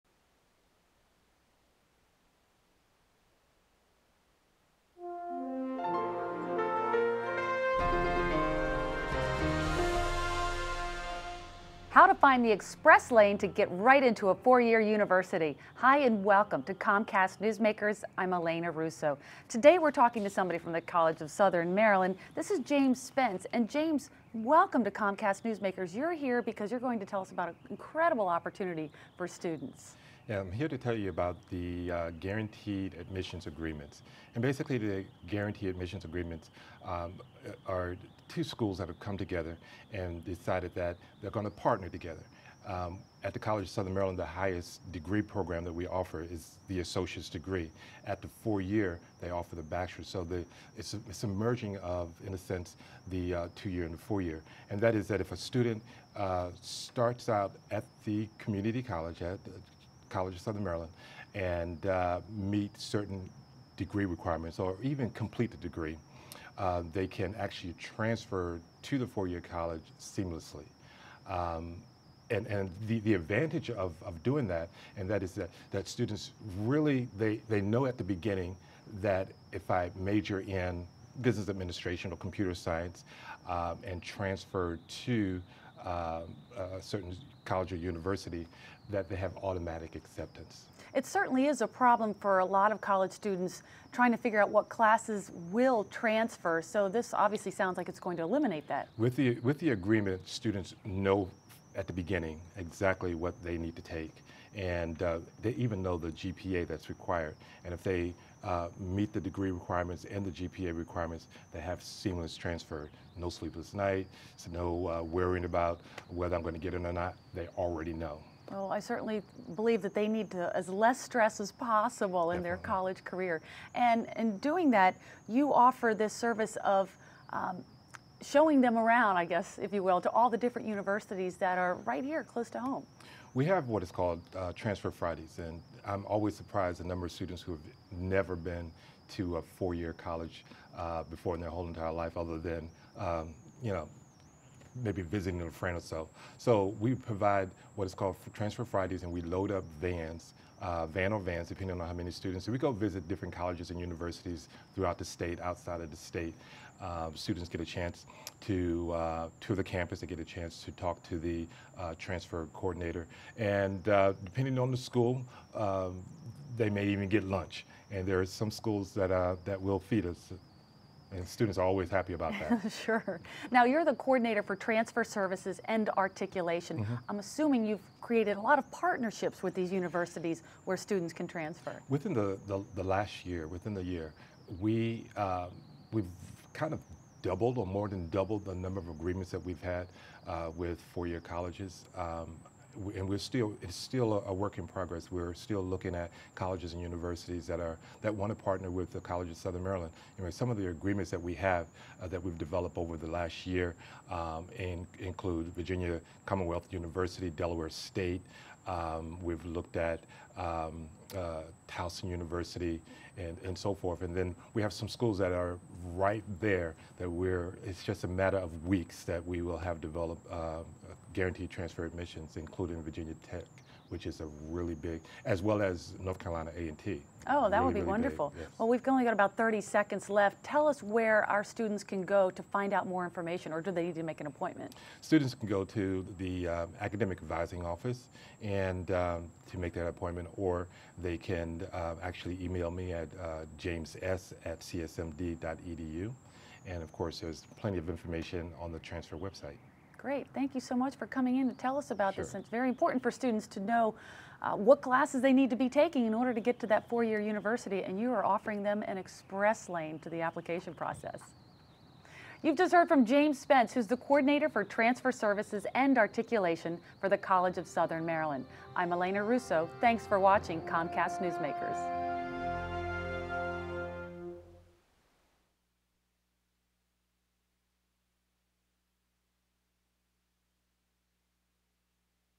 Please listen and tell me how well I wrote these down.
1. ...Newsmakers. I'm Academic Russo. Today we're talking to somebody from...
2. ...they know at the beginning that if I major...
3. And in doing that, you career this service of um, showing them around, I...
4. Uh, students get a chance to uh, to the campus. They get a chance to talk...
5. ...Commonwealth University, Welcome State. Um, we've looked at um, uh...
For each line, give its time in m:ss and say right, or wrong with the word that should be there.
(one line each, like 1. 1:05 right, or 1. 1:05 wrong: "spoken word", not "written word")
1. 0:17 wrong: "Elena", not "Academic"
2. 1:17 right
3. 2:03 wrong: "offer", not "career"
4. 2:36 right
5. 3:26 wrong: "Delaware", not "Welcome".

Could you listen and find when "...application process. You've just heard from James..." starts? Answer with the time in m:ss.
4:20.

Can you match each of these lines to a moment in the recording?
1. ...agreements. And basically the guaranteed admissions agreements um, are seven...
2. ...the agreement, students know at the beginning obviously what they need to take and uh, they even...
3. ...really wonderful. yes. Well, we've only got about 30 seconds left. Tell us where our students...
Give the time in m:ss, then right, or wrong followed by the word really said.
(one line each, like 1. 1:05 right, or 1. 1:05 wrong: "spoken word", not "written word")
1. 0:33 wrong: "two", not "seven"
2. 1:39 wrong: "exactly", not "obviously"
3. 3:47 right.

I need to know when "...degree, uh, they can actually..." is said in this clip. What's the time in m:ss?
1:05.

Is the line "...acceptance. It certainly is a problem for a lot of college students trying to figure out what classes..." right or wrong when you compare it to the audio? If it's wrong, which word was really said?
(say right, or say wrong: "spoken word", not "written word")
right.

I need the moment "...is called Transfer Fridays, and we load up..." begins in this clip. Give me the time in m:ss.
2:27.